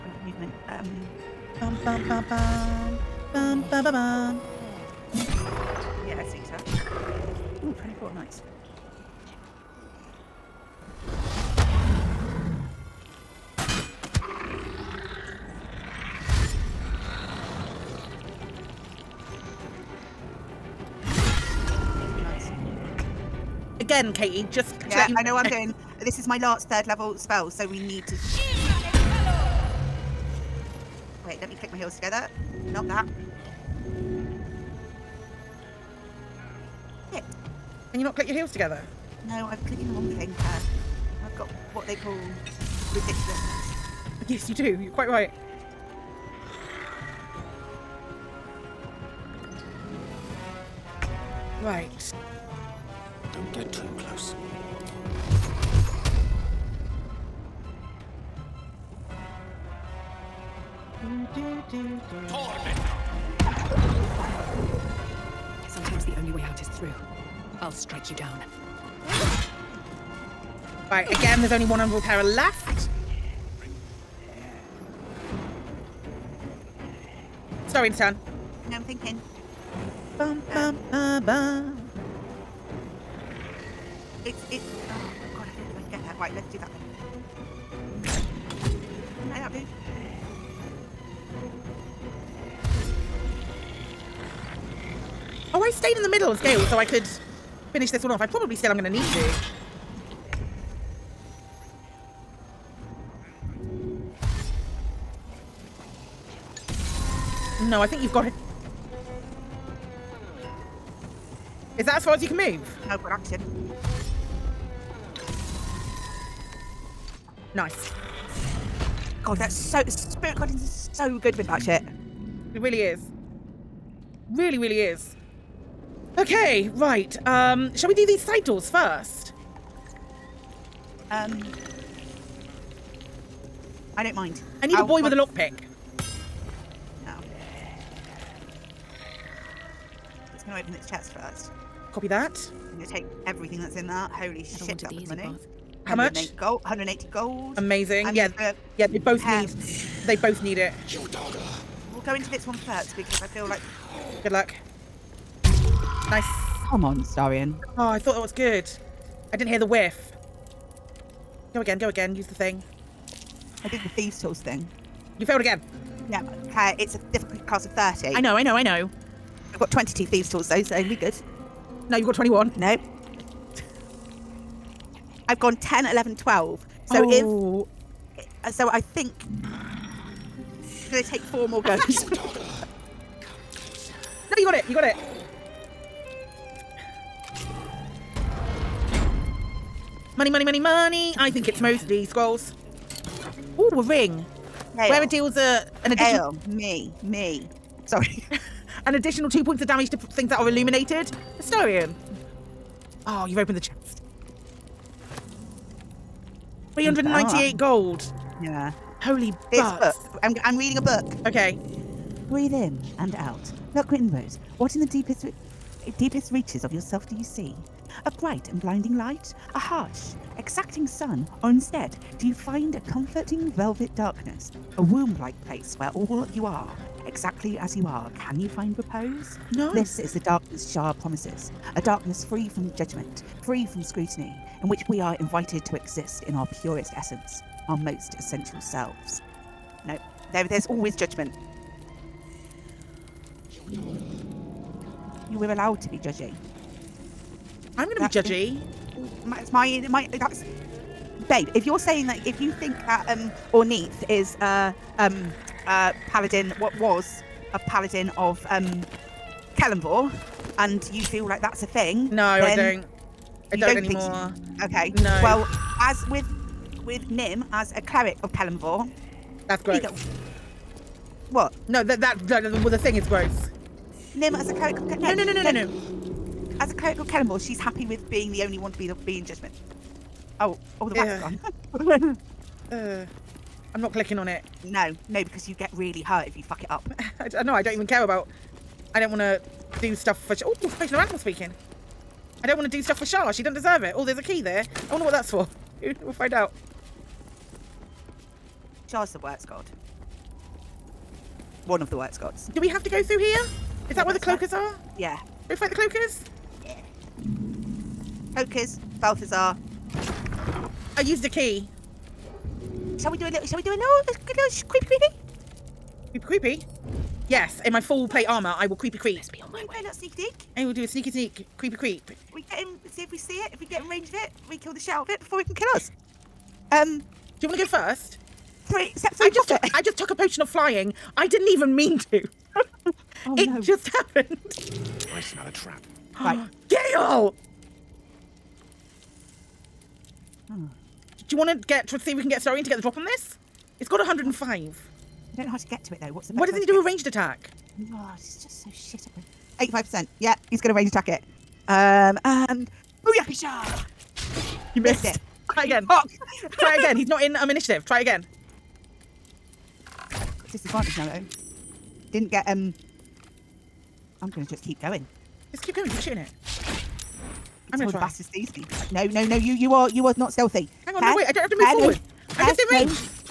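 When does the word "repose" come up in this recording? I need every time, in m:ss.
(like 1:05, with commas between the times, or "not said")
3:48.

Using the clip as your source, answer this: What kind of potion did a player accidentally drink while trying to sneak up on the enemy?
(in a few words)
potion of flying.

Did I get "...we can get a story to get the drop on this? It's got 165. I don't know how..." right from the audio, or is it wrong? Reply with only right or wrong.
wrong.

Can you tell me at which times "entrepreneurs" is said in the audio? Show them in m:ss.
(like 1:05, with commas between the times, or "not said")
not said.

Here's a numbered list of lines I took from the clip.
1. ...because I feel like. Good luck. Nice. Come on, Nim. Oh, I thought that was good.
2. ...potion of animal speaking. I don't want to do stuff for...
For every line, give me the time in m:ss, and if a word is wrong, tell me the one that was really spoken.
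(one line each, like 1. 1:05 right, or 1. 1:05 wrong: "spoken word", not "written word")
1. 2:32 wrong: "Starian", not "Nim"
2. 4:50 right.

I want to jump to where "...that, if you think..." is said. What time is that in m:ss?
4:12.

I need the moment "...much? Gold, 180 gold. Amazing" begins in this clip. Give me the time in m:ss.
2:25.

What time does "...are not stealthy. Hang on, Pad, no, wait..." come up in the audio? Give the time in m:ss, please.
6:10.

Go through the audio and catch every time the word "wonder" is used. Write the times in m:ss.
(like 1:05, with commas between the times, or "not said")
4:54.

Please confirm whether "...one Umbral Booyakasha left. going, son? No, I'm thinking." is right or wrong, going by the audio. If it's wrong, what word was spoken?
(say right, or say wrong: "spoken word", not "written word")
wrong: "Tower", not "Booyakasha".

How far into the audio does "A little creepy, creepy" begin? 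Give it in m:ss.
5:13.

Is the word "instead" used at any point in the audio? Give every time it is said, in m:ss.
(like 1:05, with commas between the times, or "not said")
3:41.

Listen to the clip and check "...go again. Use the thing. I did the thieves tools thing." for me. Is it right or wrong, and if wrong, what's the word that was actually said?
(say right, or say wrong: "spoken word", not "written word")
right.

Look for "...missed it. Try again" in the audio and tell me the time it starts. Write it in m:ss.
5:55.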